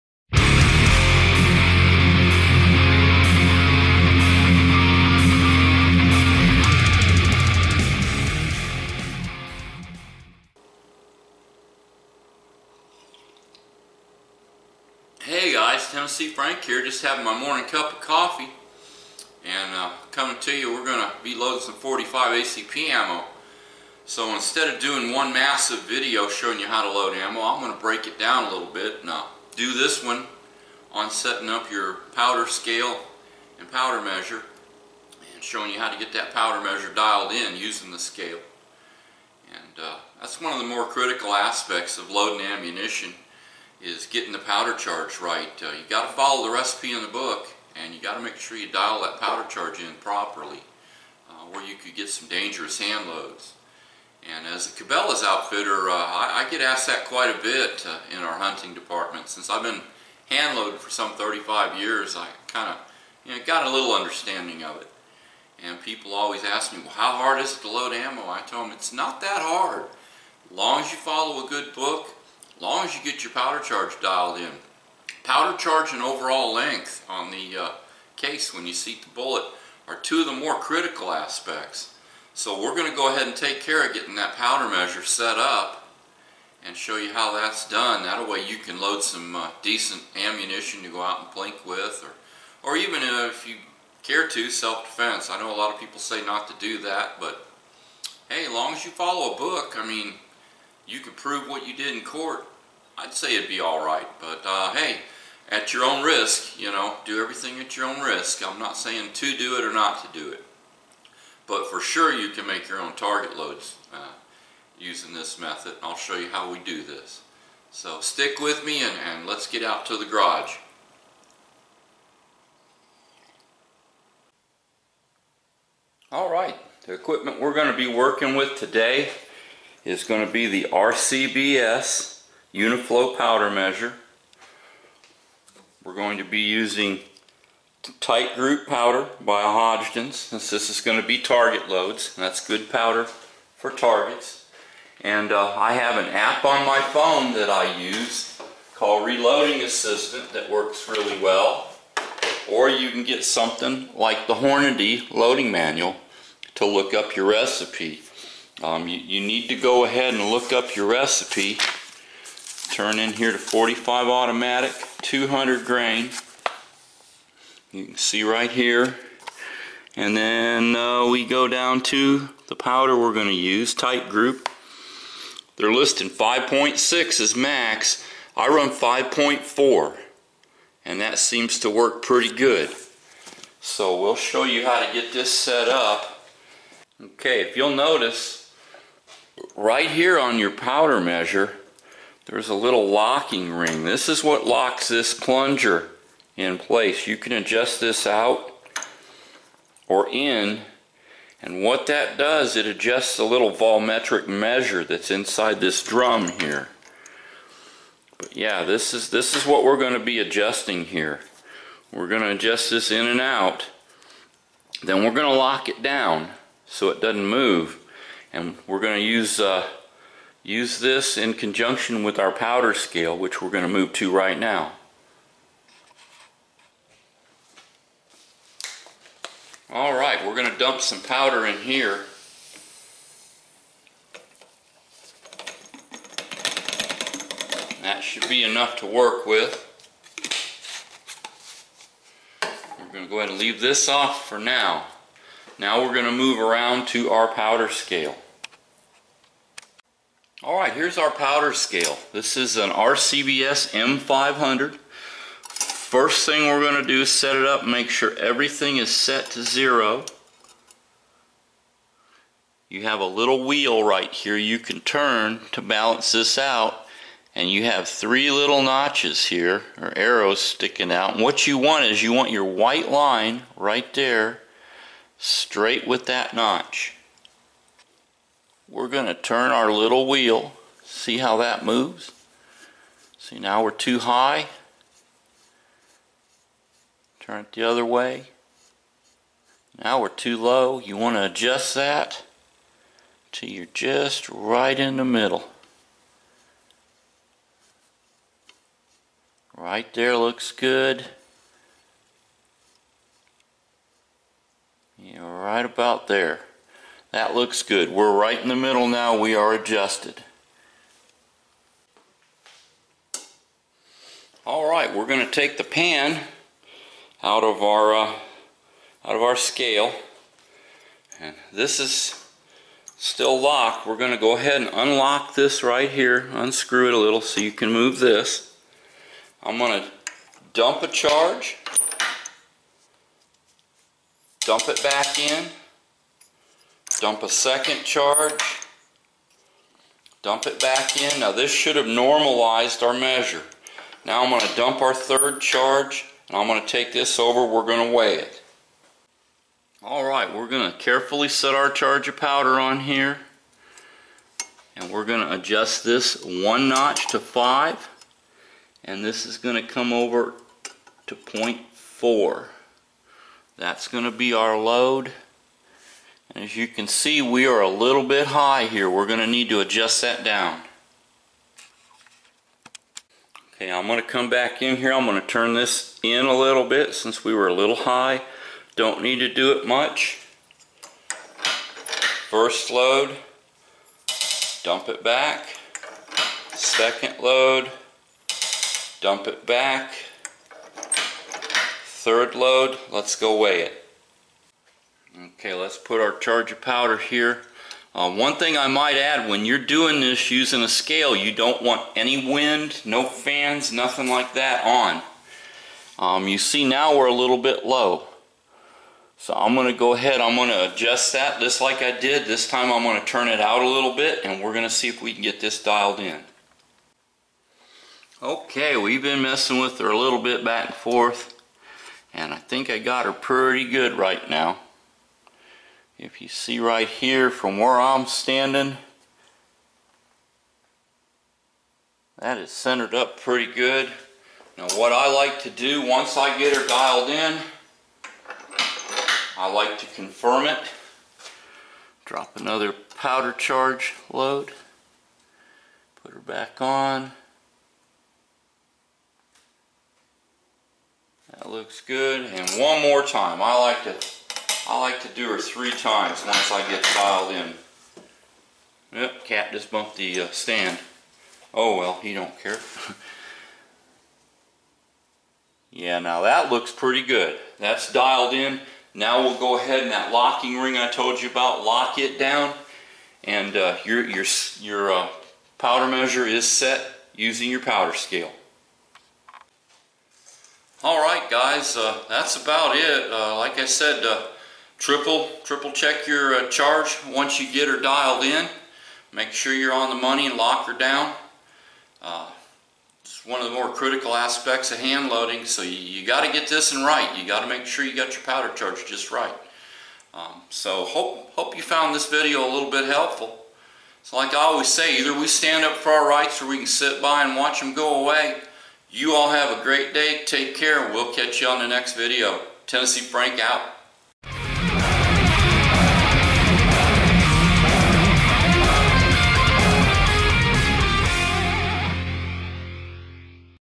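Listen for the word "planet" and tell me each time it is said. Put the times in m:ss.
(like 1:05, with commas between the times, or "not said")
not said.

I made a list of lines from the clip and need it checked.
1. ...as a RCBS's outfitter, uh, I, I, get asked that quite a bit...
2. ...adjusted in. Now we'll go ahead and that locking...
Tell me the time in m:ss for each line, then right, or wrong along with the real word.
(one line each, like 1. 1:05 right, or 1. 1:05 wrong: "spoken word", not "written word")
1. 0:54 wrong: "Cabela", not "RCBS"
2. 7:47 wrong: "dialed", not "adjusted".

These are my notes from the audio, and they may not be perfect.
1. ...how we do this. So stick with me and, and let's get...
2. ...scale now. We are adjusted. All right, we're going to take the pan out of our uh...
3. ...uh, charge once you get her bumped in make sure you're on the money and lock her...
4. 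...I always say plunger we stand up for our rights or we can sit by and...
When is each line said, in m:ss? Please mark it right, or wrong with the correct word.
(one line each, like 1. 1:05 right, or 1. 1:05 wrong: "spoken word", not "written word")
1. 1:56 right
2. 5:08 wrong: "middle", not "scale"
3. 8:06 wrong: "dialed", not "bumped"
4. 8:24 wrong: "either", not "plunger".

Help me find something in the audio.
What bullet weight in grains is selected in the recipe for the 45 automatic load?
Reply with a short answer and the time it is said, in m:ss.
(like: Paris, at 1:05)
200 grain, at 2:45.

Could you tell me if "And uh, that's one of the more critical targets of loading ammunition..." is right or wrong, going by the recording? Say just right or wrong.
wrong.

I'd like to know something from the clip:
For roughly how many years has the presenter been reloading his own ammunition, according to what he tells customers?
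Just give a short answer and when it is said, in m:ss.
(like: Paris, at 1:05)
35 years, at 1:01.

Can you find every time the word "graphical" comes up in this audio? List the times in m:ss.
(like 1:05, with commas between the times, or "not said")
not said.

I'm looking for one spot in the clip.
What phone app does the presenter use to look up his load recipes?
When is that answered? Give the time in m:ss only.
2:29.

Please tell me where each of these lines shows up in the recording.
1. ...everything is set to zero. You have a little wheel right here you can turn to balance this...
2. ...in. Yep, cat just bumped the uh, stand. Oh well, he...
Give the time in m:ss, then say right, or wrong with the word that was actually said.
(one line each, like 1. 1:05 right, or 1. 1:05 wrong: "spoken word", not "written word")
1. 4:18 right
2. 7:37 right.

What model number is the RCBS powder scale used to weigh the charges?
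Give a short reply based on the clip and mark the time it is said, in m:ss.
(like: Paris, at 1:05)
M500, at 4:13.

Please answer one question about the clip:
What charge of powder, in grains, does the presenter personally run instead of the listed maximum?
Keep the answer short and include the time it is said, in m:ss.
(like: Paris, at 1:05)
5.4, at 2:58.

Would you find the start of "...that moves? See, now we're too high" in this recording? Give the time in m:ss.
4:41.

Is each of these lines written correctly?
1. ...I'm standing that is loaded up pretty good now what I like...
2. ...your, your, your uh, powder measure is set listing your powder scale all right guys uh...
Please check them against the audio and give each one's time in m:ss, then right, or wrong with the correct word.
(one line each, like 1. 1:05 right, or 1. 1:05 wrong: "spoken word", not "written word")
1. 7:07 wrong: "centered", not "loaded"
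2. 7:53 wrong: "using", not "listing".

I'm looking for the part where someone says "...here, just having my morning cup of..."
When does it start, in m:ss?
0:16.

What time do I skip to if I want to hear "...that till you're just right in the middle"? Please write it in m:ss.
4:51.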